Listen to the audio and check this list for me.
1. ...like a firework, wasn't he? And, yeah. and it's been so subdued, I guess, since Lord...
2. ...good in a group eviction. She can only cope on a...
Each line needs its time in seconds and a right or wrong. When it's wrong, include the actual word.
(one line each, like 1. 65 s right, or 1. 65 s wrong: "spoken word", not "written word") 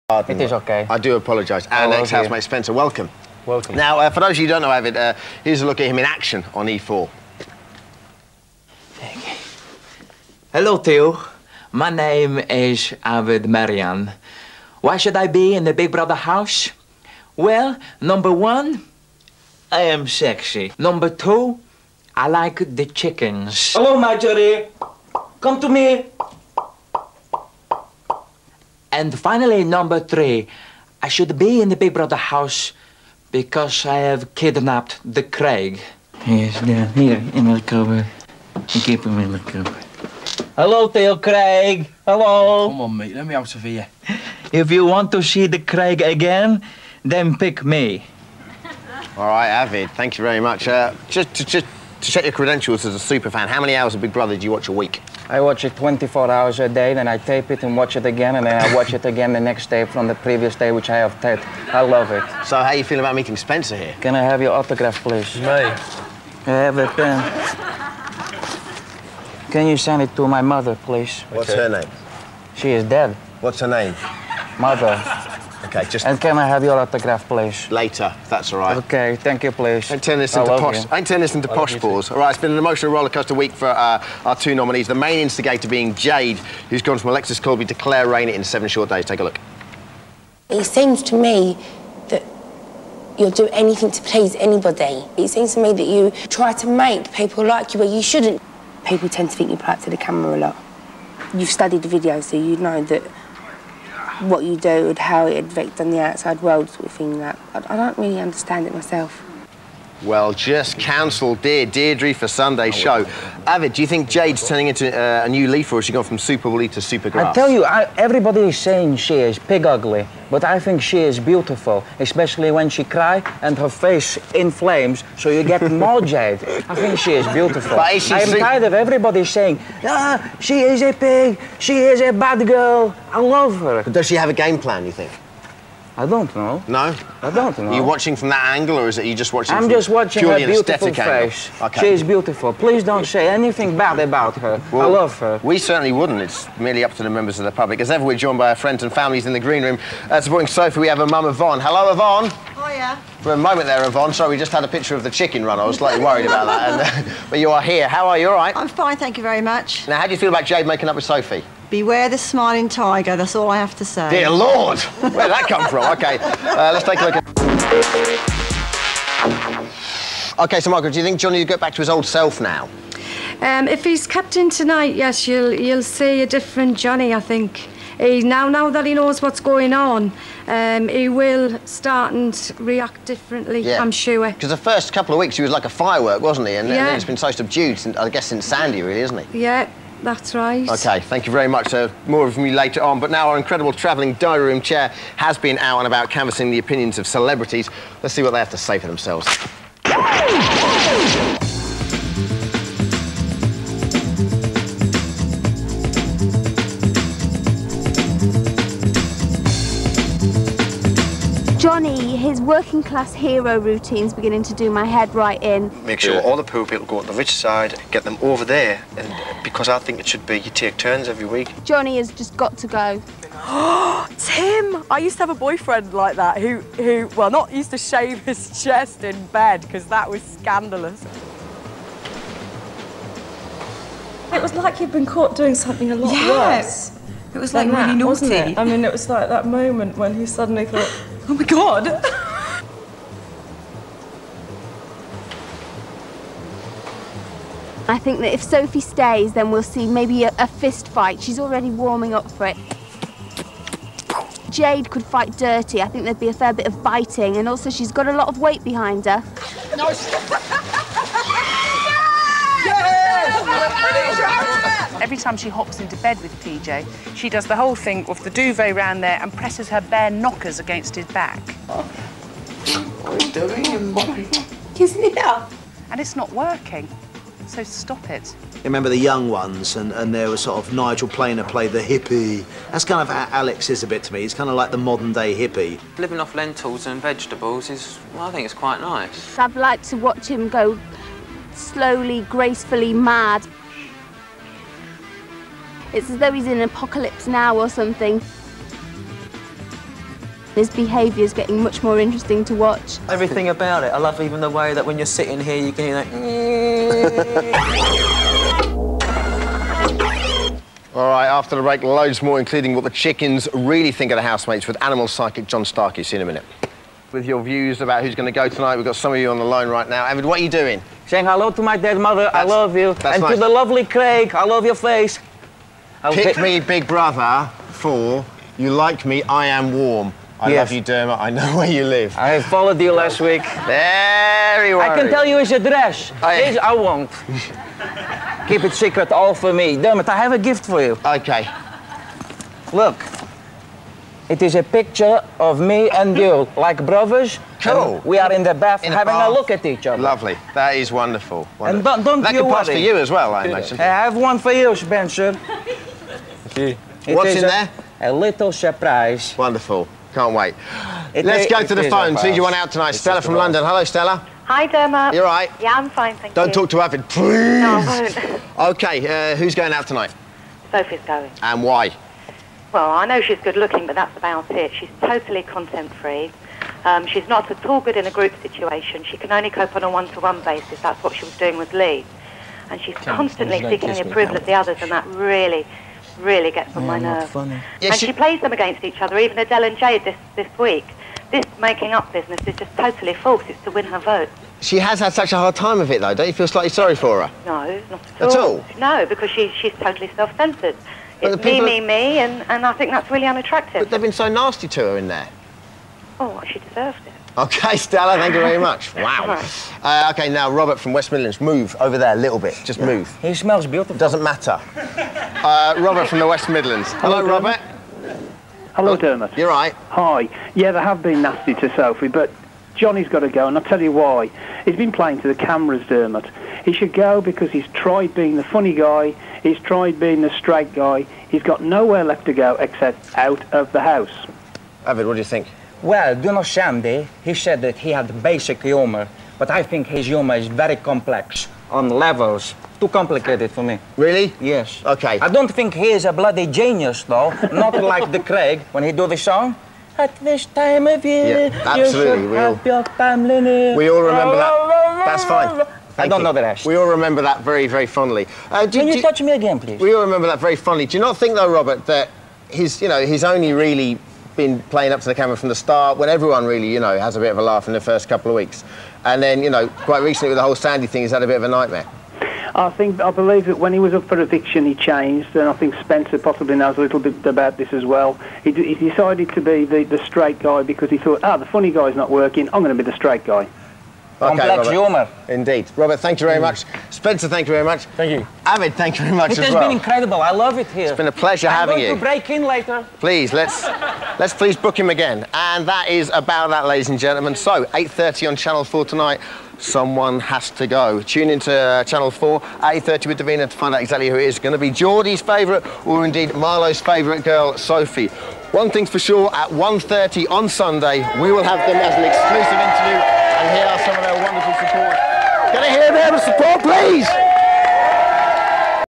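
1. 185 s wrong: "Sandy", not "Lord"
2. 377 s wrong: "situation", not "eviction".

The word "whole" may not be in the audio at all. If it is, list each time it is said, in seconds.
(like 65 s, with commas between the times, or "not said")
267 s, 470 s.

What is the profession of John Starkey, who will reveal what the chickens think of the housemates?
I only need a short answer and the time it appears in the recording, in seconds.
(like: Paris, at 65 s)
Animal psychic, at 314 s.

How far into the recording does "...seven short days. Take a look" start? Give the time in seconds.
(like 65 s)
88 s.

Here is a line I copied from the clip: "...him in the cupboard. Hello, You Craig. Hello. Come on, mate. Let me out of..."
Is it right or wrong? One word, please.
wrong.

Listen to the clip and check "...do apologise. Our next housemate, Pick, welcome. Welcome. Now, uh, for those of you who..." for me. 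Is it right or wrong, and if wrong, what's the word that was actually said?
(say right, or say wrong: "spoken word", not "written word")
wrong: "Spencer", not "Pick".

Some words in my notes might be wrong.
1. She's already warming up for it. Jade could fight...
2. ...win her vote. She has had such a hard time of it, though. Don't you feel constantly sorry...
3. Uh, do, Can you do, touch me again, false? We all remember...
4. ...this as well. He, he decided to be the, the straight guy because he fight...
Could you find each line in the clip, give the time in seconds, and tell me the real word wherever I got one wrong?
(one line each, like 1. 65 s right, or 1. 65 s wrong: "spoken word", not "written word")
1. 251 s right
2. 393 s wrong: "slightly", not "constantly"
3. 458 s wrong: "please", not "false"
4. 477 s wrong: "thought", not "fight".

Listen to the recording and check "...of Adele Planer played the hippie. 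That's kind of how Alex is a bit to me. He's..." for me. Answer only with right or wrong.
wrong.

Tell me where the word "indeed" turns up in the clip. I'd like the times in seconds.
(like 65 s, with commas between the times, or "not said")
485 s, 506 s.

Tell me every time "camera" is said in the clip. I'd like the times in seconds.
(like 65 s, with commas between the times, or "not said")
99 s, 425 s, 465 s.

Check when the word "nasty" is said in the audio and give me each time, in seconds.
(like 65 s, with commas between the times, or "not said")
404 s, 421 s.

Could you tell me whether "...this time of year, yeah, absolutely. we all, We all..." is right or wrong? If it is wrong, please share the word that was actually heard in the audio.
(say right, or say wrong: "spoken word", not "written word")
right.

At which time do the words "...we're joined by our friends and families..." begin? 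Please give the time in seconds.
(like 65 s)
148 s.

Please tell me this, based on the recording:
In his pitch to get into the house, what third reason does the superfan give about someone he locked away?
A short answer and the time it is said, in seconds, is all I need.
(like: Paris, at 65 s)
Kidnapped the Craig, at 33 s.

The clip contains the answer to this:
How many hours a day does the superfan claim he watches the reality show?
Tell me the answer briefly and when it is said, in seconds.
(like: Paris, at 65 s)
24, at 55 s.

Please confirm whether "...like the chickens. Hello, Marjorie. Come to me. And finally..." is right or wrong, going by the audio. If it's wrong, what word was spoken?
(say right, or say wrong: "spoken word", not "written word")
right.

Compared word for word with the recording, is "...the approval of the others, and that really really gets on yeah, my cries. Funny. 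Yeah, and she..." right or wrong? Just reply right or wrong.
wrong.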